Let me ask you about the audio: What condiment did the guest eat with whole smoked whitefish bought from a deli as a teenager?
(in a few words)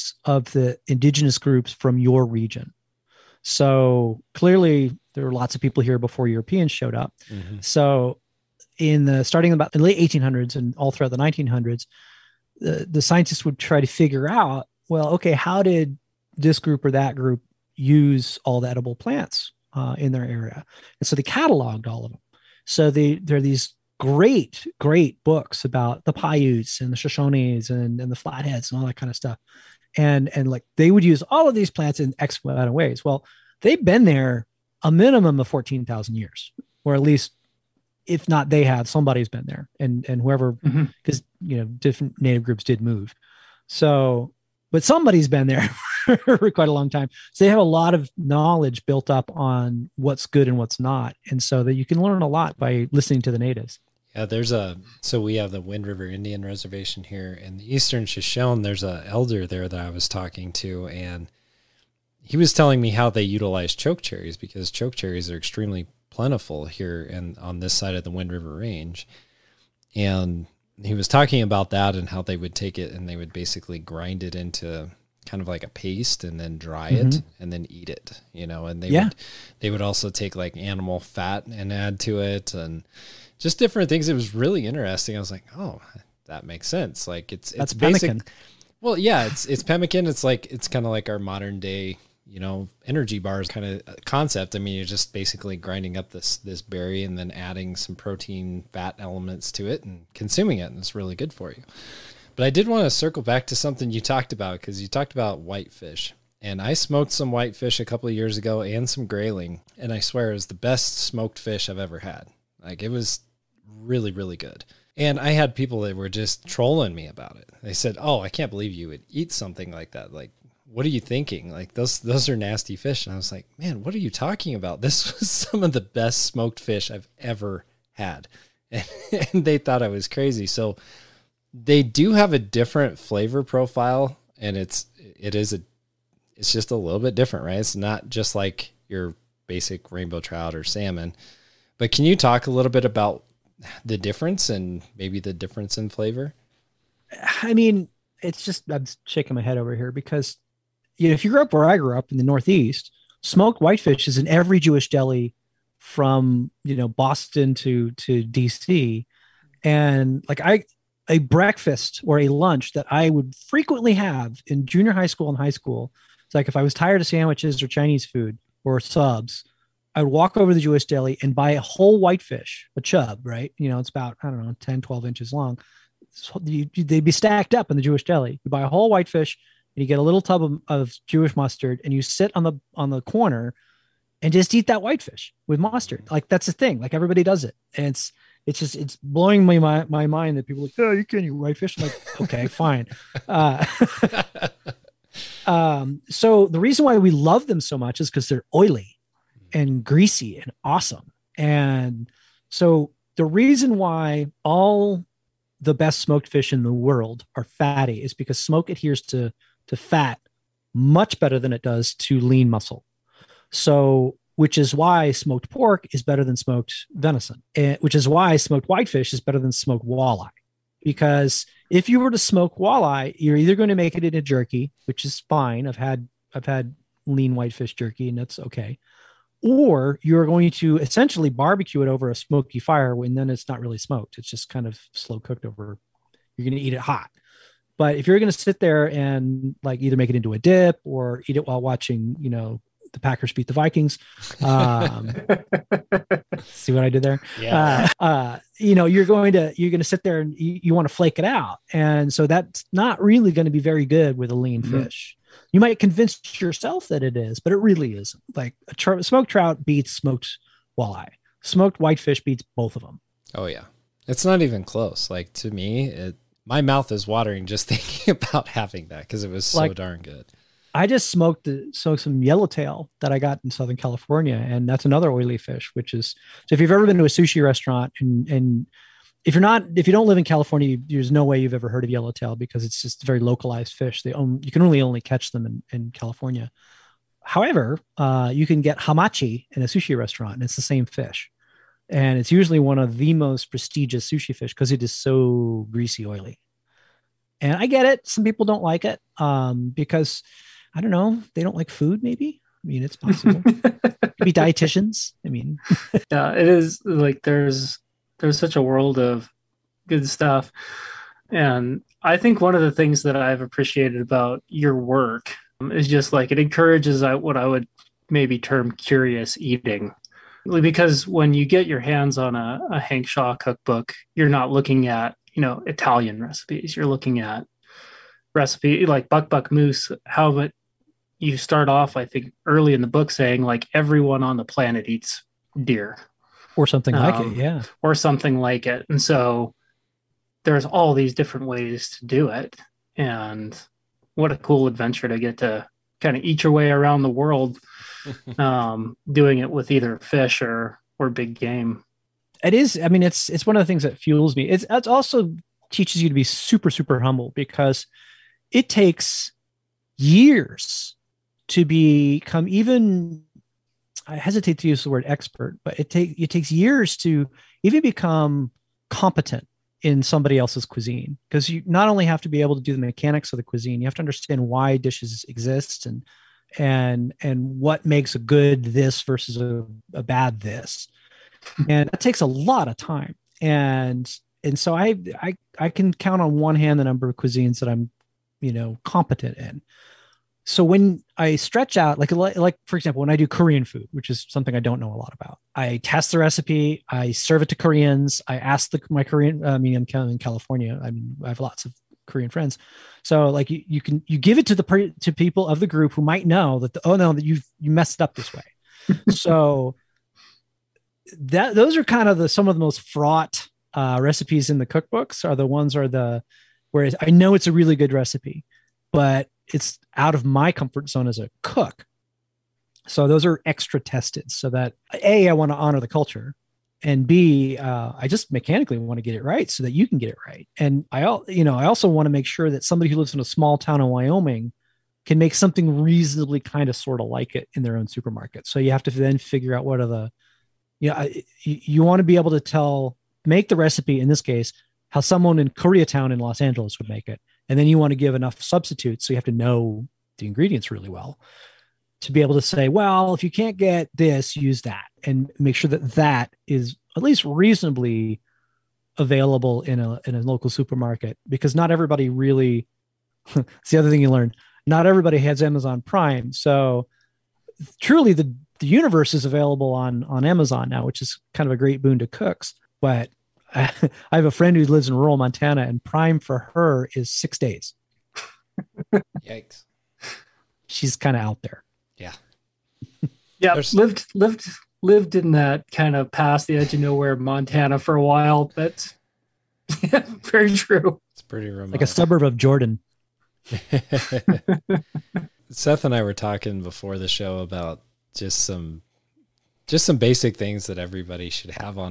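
Jewish mustard.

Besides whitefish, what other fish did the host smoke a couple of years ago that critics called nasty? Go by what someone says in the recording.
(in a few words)
Grayling.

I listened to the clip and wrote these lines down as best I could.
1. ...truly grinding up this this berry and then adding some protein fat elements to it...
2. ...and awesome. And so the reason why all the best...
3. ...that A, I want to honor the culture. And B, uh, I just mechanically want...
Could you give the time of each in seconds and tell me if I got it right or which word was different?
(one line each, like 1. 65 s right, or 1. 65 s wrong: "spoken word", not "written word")
1. 95 s wrong: "basically", not "truly"
2. 200 s right
3. 424 s right.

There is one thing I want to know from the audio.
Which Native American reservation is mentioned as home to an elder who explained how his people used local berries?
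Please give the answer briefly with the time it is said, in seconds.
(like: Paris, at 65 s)
Wind River Indian Reservation, at 55 s.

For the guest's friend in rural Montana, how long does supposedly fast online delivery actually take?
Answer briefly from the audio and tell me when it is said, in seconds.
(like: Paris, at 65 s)
6 days, at 477 s.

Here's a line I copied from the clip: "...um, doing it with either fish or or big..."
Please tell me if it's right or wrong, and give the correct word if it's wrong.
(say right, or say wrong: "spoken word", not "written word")
right.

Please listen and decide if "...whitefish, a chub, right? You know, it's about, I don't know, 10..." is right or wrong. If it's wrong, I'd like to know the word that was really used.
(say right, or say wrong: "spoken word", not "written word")
right.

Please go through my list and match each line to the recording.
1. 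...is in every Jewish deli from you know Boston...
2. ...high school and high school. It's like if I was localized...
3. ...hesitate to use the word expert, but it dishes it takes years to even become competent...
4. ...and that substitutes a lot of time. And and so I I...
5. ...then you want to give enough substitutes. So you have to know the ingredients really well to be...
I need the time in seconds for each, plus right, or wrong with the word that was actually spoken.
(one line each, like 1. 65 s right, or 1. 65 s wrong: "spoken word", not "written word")
1. 154 s right
2. 164 s wrong: "tired", not "localized"
3. 364 s wrong: "takes", not "dishes"
4. 381 s wrong: "takes", not "substitutes"
5. 447 s right.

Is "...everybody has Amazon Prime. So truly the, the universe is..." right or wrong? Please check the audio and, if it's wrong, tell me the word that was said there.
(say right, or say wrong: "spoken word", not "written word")
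right.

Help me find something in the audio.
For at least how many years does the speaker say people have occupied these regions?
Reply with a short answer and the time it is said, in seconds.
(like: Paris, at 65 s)
14,000 years, at 35 s.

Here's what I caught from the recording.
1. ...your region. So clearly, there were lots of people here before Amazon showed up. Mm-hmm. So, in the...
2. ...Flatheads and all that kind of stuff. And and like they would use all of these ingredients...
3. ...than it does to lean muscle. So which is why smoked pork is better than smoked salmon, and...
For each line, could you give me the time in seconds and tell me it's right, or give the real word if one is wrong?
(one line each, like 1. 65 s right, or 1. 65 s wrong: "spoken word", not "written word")
1. 1 s wrong: "Europeans", not "Amazon"
2. 28 s wrong: "plants", not "ingredients"
3. 211 s wrong: "venison", not "salmon".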